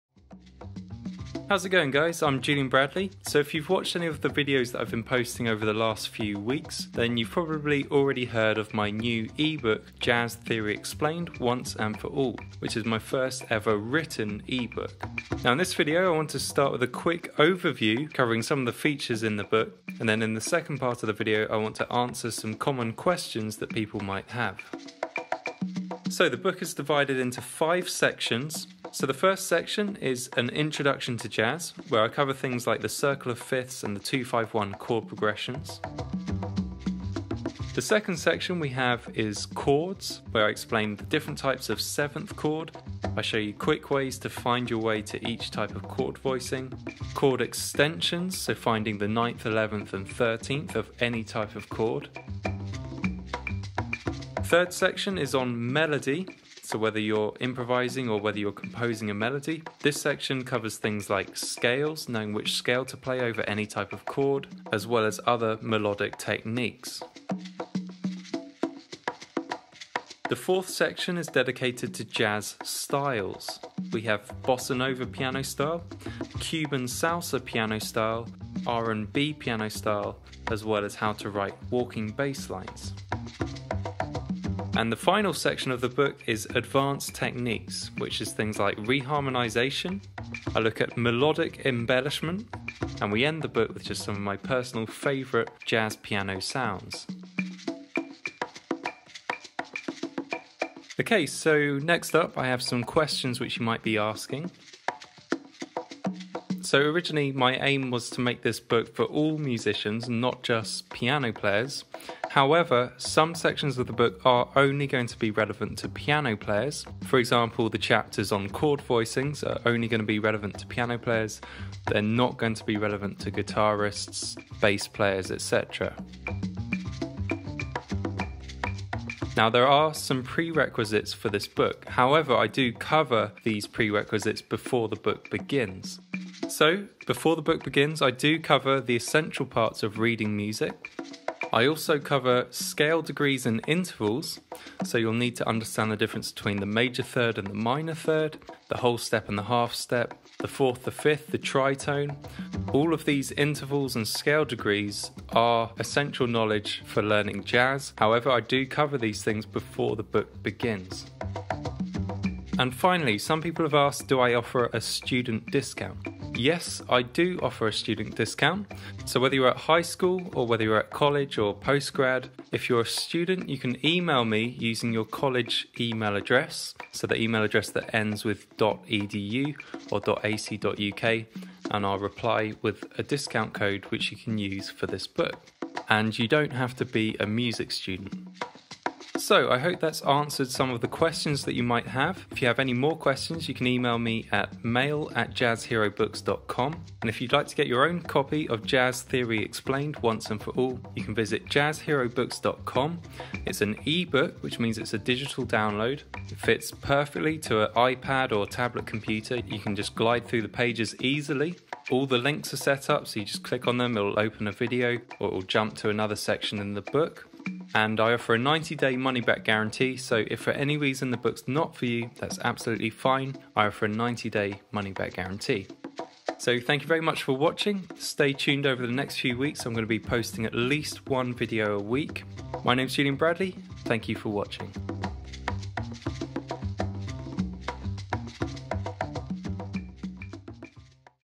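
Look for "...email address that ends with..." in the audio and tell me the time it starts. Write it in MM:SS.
02:57.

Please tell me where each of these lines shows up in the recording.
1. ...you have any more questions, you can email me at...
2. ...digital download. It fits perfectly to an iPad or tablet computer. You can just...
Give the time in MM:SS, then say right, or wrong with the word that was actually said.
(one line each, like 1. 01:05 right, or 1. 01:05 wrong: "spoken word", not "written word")
1. 03:12 right
2. 03:24 right.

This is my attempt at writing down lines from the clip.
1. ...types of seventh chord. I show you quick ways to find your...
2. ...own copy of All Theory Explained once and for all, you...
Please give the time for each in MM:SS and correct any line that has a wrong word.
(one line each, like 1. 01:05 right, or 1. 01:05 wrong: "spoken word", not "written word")
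1. 00:41 right
2. 03:17 wrong: "Jazz", not "All".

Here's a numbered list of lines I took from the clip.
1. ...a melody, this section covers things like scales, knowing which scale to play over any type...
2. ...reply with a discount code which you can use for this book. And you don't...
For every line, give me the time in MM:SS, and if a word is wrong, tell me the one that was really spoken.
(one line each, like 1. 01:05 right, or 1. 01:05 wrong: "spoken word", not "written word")
1. 00:59 right
2. 03:01 right.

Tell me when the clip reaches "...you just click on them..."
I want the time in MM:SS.
03:33.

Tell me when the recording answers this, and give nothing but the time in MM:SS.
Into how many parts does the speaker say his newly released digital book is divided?
00:27.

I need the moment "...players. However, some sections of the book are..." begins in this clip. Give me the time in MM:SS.
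01:51.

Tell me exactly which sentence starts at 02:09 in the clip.
Now, there are some prerequisites for this book.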